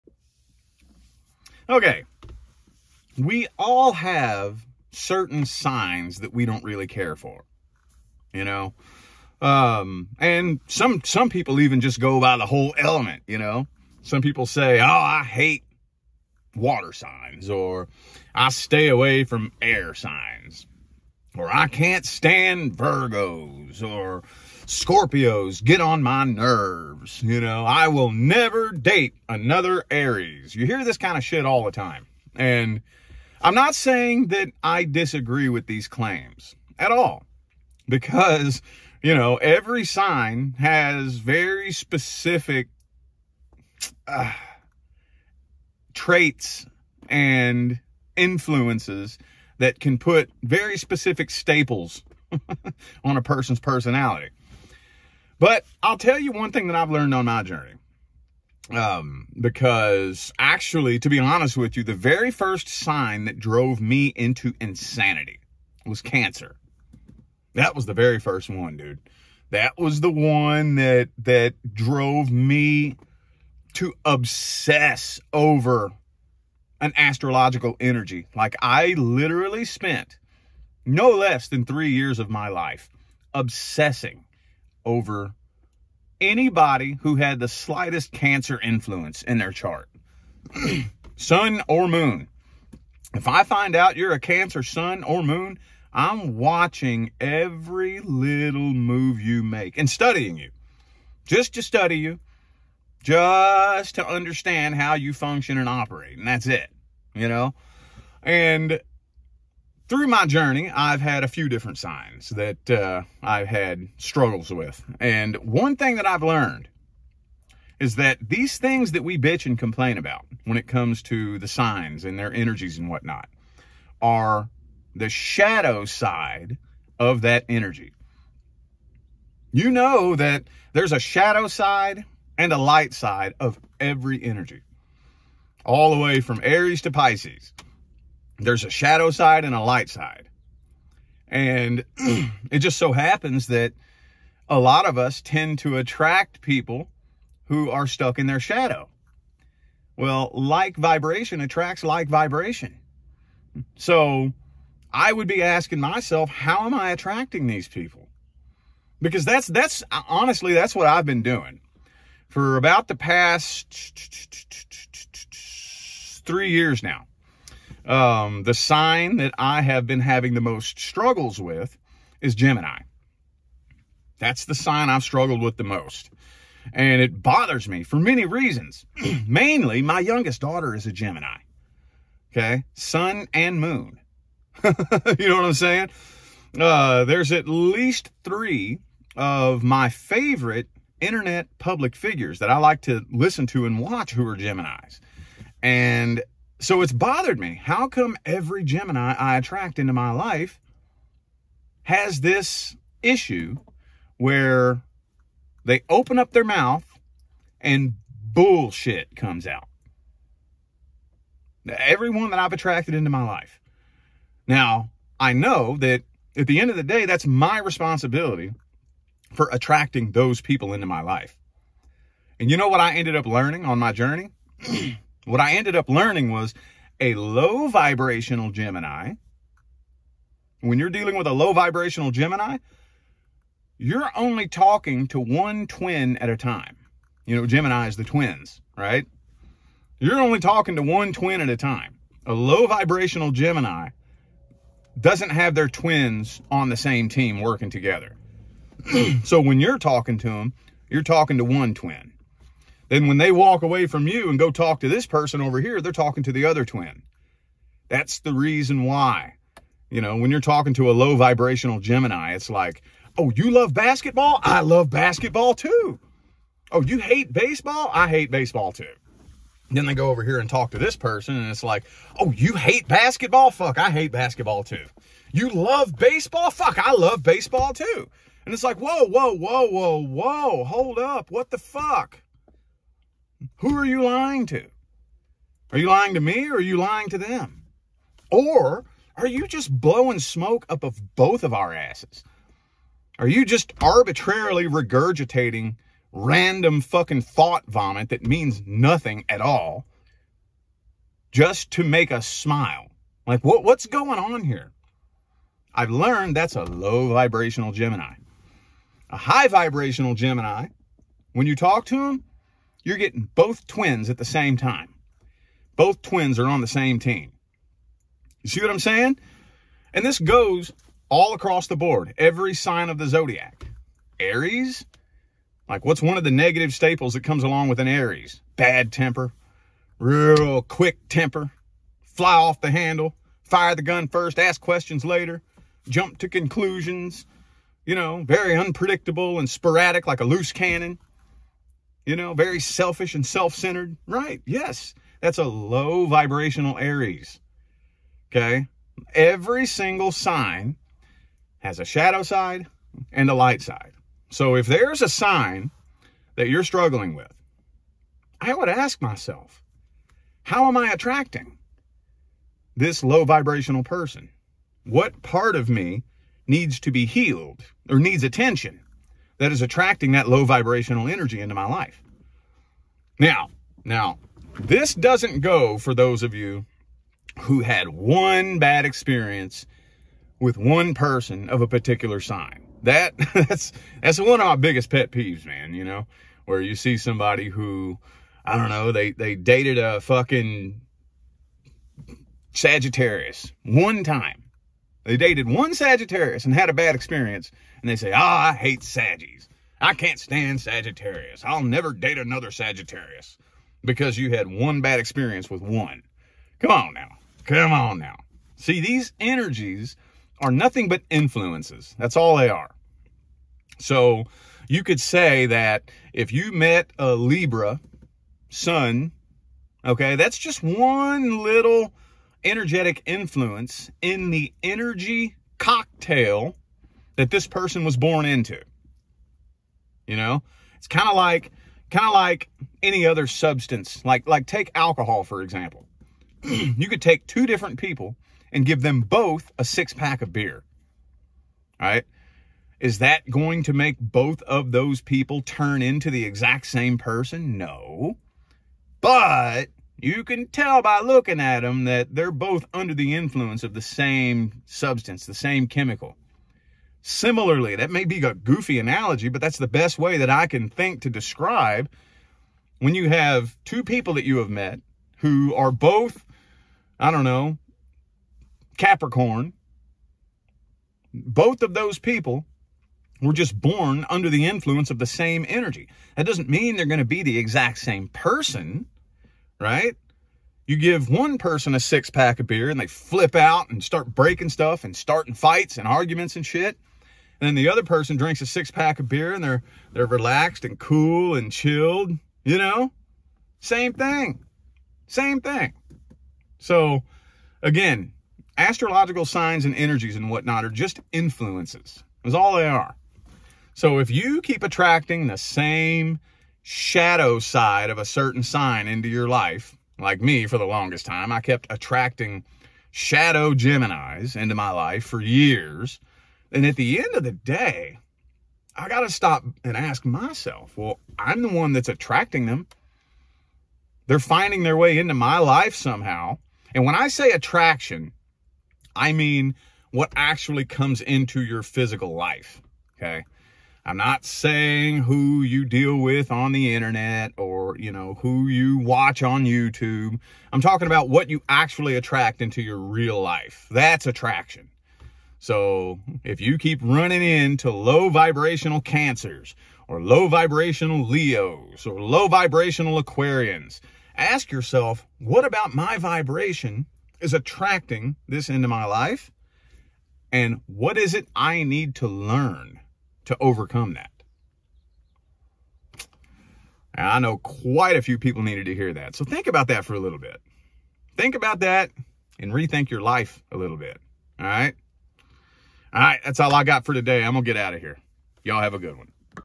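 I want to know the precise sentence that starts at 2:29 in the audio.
Well, like vibration attracts like vibration.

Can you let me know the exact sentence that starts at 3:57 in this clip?
You know, Gemini is the twins, right?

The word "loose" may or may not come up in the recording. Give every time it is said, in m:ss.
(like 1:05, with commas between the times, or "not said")
5:40.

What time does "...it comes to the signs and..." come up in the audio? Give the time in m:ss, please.
2:00.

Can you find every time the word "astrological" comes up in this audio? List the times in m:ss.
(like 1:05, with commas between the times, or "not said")
1:16, 8:18.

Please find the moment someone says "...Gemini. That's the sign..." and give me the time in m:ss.
2:52.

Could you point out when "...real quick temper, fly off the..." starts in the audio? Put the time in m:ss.
5:29.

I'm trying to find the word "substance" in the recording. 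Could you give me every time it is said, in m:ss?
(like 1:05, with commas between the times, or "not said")
7:13, 7:34.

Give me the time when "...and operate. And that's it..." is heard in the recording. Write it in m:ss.
1:45.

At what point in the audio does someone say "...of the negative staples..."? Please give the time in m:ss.
5:26.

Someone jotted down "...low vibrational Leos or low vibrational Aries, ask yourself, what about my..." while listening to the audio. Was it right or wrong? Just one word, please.
wrong.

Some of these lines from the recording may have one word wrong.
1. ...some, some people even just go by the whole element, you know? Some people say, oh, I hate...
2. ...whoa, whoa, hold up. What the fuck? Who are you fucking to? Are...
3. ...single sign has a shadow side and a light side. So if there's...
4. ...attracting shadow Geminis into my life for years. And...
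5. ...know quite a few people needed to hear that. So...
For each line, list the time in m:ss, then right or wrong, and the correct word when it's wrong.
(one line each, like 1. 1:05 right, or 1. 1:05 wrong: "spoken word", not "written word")
1. 0:10 right
2. 4:39 wrong: "lying", not "fucking"
3. 5:49 right
4. 8:31 right
5. 9:27 right.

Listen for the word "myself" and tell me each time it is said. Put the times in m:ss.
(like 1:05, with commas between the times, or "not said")
2:35, 5:59, 8:40.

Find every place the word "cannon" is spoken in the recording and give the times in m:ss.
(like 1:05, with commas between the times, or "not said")
5:40.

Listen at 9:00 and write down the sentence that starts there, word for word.
I'm talking about what you actually attract into your real life.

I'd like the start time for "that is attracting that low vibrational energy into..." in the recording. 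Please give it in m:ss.
6:09.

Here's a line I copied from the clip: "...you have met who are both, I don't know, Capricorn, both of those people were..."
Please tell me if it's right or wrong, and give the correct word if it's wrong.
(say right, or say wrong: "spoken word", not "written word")
right.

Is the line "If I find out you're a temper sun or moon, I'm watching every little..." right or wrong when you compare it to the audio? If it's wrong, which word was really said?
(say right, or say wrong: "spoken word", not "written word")
wrong: "cancer", not "temper".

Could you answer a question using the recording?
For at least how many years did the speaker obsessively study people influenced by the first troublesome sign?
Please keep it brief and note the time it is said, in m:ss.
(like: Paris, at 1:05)
3, at 1:21.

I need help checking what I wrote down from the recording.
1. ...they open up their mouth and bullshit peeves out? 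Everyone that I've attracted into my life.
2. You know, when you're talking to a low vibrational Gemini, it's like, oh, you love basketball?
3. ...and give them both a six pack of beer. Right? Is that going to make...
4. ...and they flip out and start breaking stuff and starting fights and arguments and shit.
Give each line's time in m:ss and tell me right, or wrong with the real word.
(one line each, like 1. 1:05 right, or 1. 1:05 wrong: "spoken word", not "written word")
1. 3:25 wrong: "comes", not "peeves"
2. 4:19 right
3. 7:18 right
4. 8:02 right.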